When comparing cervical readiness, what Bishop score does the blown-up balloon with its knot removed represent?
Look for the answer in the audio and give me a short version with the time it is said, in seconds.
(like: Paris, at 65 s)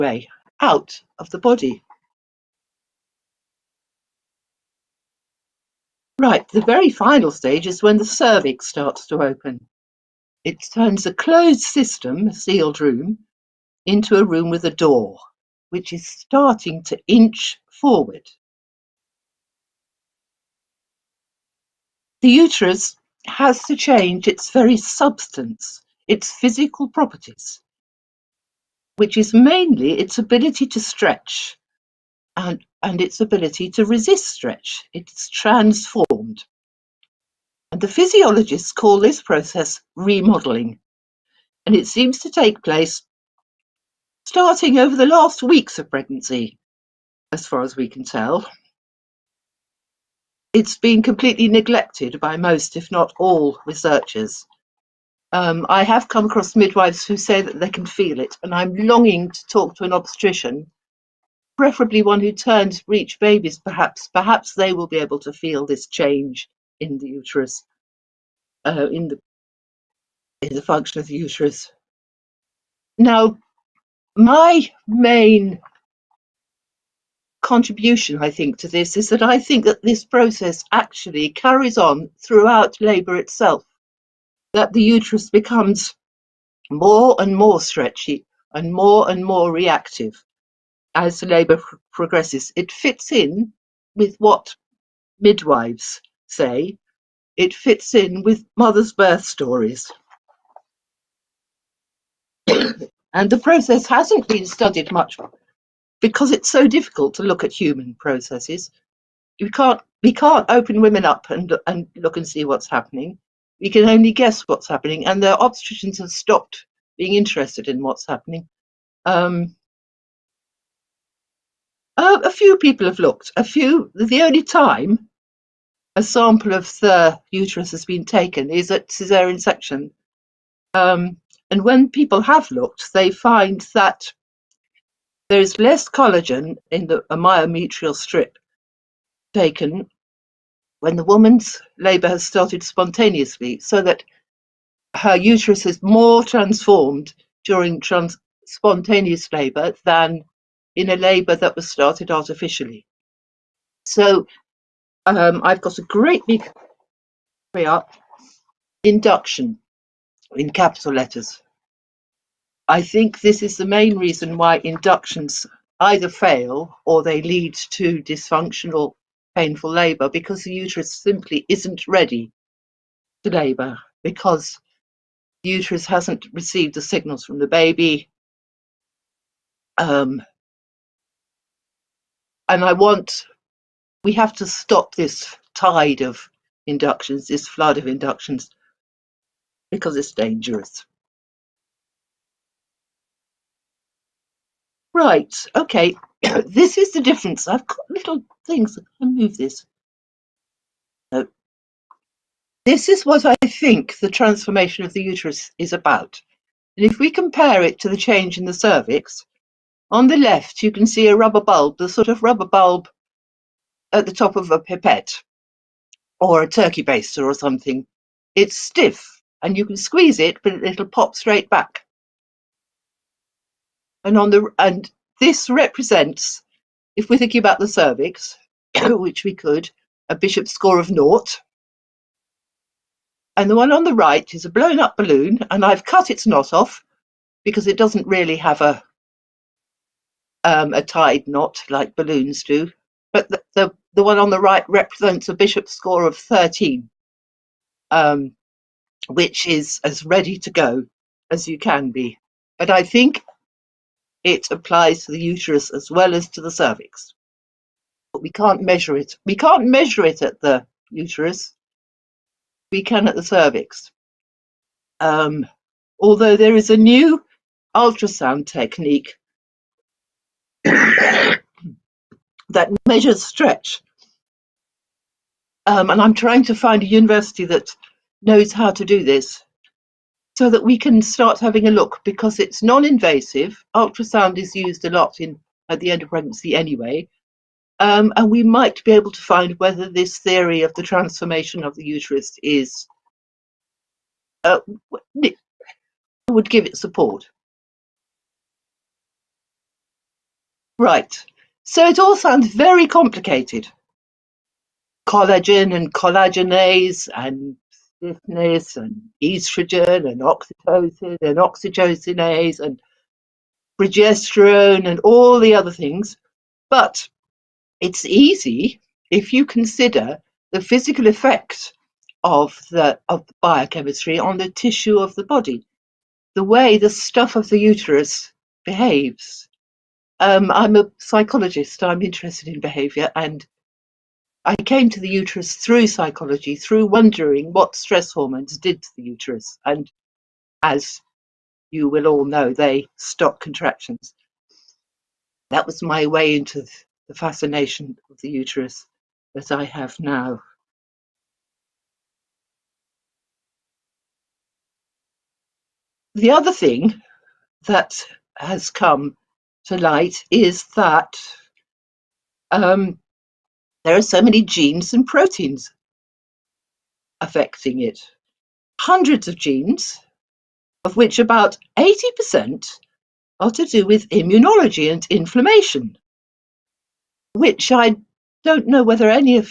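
13, at 246 s.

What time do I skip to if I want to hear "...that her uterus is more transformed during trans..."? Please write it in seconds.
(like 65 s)
143 s.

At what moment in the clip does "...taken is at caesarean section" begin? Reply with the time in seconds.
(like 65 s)
128 s.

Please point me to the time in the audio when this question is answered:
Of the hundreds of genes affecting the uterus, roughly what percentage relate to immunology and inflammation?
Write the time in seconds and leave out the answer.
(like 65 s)
371 s.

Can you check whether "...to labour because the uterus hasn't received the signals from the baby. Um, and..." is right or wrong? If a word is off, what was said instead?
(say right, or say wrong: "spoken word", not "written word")
right.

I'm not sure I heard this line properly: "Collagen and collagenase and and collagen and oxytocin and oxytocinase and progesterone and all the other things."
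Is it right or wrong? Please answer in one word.
wrong.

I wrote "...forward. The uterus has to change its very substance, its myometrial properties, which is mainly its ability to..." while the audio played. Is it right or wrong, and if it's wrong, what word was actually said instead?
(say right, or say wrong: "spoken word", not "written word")
wrong: "physical", not "myometrial".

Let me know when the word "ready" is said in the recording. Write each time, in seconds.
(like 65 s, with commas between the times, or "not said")
171 s, 250 s.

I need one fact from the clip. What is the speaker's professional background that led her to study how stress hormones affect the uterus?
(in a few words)
Psychologist.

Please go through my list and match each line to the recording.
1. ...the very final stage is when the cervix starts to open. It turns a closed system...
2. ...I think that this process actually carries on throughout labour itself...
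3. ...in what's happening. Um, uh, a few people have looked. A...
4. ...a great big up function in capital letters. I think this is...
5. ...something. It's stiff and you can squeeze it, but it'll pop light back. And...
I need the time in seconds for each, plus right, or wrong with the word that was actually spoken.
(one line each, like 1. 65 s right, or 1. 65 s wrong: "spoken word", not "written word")
1. 6 s right
2. 79 s right
3. 117 s right
4. 155 s wrong: "induction", not "function"
5. 217 s wrong: "straight", not "light".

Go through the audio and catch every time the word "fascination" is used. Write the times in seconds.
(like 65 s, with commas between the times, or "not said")
347 s.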